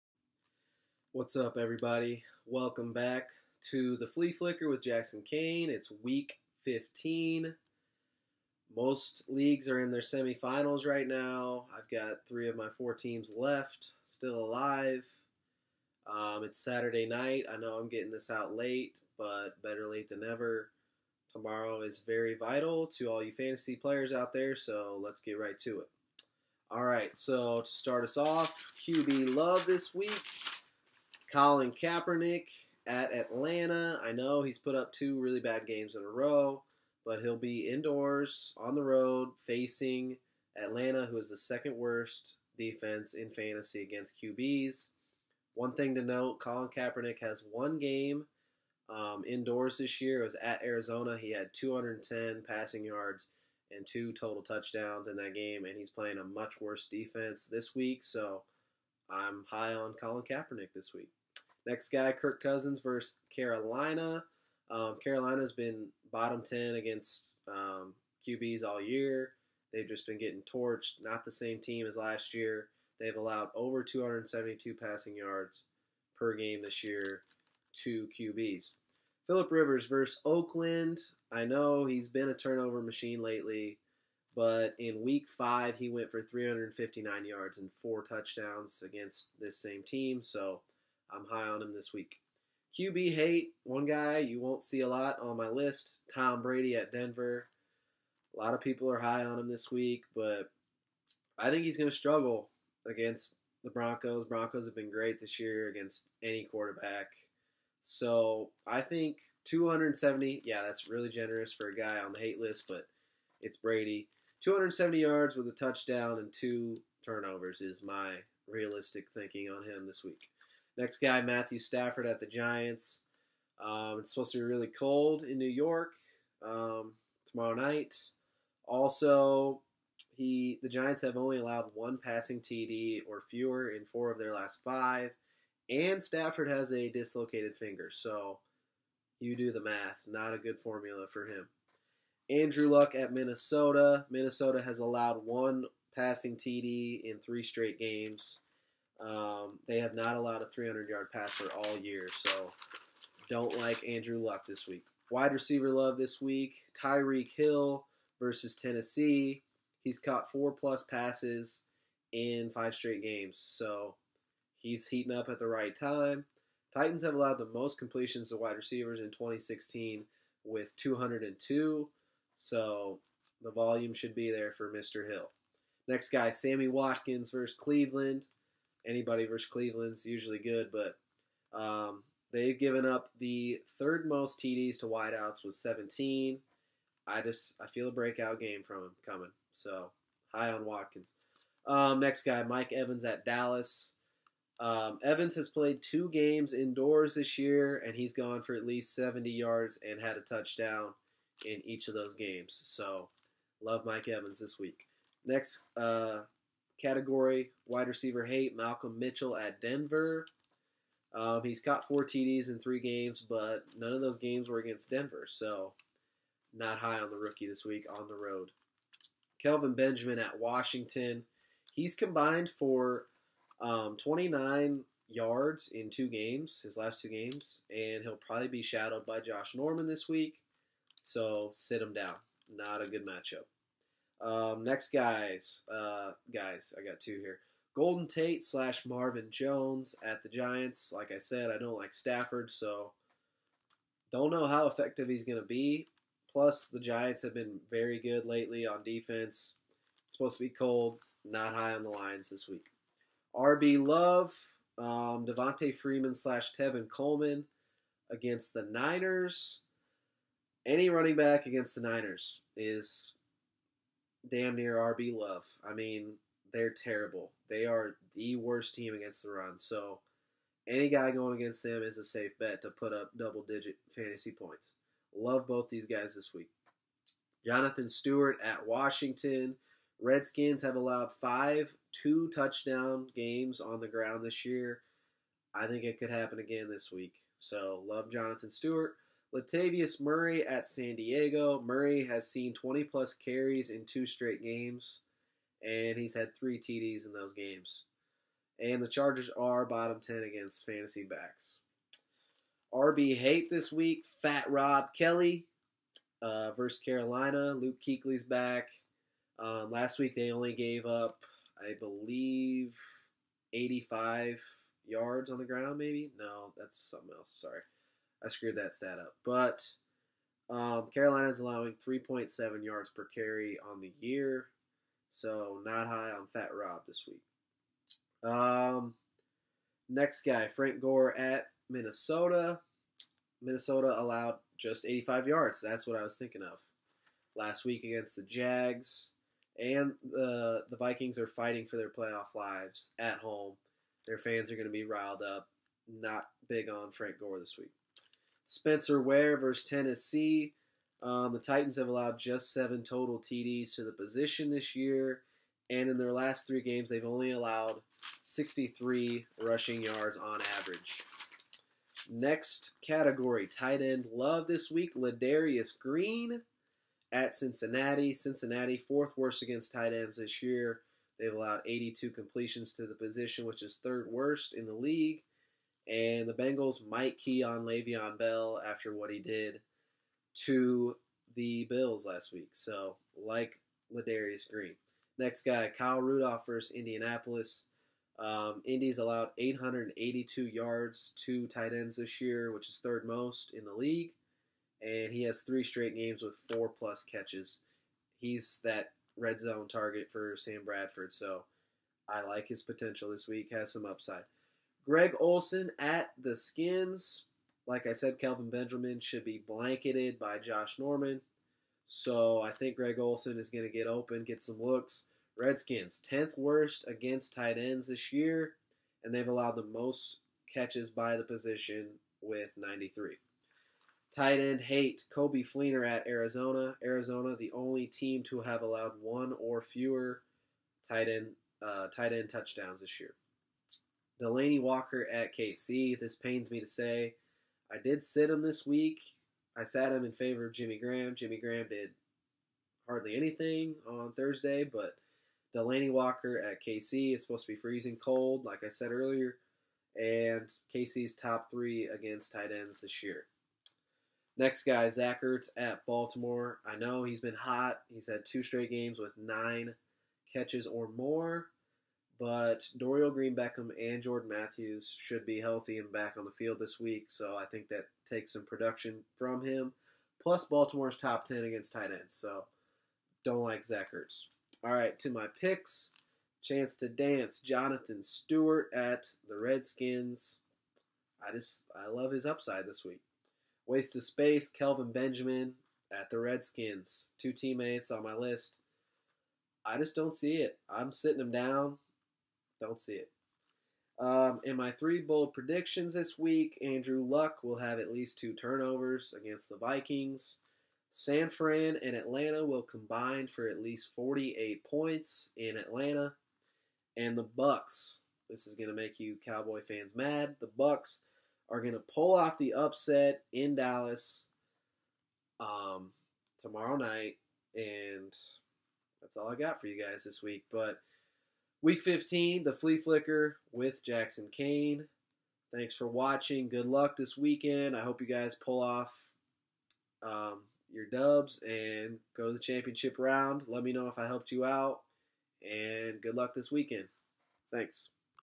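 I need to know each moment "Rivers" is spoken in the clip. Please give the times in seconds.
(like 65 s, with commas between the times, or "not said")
79 s.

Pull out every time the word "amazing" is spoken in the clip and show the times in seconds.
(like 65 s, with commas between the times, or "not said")
not said.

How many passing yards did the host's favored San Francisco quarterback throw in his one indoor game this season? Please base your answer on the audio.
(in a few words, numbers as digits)
210.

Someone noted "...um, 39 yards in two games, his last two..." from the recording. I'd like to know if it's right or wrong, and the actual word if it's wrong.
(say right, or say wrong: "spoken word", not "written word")
wrong: "29", not "39".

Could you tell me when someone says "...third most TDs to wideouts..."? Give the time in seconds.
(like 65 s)
183 s.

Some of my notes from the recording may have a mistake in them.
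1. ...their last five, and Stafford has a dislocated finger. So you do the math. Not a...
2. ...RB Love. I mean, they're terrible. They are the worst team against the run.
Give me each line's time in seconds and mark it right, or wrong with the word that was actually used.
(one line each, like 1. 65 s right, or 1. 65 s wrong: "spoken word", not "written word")
1. 134 s right
2. 264 s right.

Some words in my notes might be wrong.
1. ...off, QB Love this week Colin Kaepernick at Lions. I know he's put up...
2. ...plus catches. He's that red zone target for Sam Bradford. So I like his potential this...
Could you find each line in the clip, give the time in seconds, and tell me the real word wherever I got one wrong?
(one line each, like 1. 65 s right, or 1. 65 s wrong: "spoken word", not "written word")
1. 28 s wrong: "Atlanta", not "Lions"
2. 396 s right.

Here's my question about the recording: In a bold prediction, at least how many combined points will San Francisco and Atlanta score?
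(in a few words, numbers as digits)
48.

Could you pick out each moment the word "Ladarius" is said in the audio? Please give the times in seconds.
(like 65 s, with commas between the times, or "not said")
364 s, 383 s.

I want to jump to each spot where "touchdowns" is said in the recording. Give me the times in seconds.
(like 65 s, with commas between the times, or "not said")
54 s, 88 s, 115 s, 200 s, 282 s, 432 s.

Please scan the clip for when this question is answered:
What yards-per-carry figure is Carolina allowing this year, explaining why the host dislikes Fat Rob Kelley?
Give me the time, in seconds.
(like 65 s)
321 s.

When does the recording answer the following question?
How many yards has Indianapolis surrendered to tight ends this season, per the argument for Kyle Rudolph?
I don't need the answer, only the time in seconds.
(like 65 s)
389 s.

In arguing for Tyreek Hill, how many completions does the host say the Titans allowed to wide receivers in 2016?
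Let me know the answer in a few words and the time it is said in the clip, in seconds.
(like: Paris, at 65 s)
202, at 170 s.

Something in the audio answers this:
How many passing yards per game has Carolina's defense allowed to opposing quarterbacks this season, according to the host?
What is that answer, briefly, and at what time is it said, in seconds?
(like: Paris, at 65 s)
272, at 73 s.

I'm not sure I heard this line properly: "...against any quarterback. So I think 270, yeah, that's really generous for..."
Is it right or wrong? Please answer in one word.
right.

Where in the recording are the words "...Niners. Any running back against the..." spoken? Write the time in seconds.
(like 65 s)
258 s.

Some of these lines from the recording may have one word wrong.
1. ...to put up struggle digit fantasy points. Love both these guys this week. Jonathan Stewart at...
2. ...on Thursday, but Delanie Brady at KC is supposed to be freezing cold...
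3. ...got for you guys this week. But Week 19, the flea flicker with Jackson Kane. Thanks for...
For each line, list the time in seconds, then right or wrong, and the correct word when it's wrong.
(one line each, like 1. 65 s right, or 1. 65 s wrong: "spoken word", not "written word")
1. 272 s wrong: "double", not "struggle"
2. 443 s wrong: "Walker", not "Brady"
3. 519 s wrong: "15", not "19".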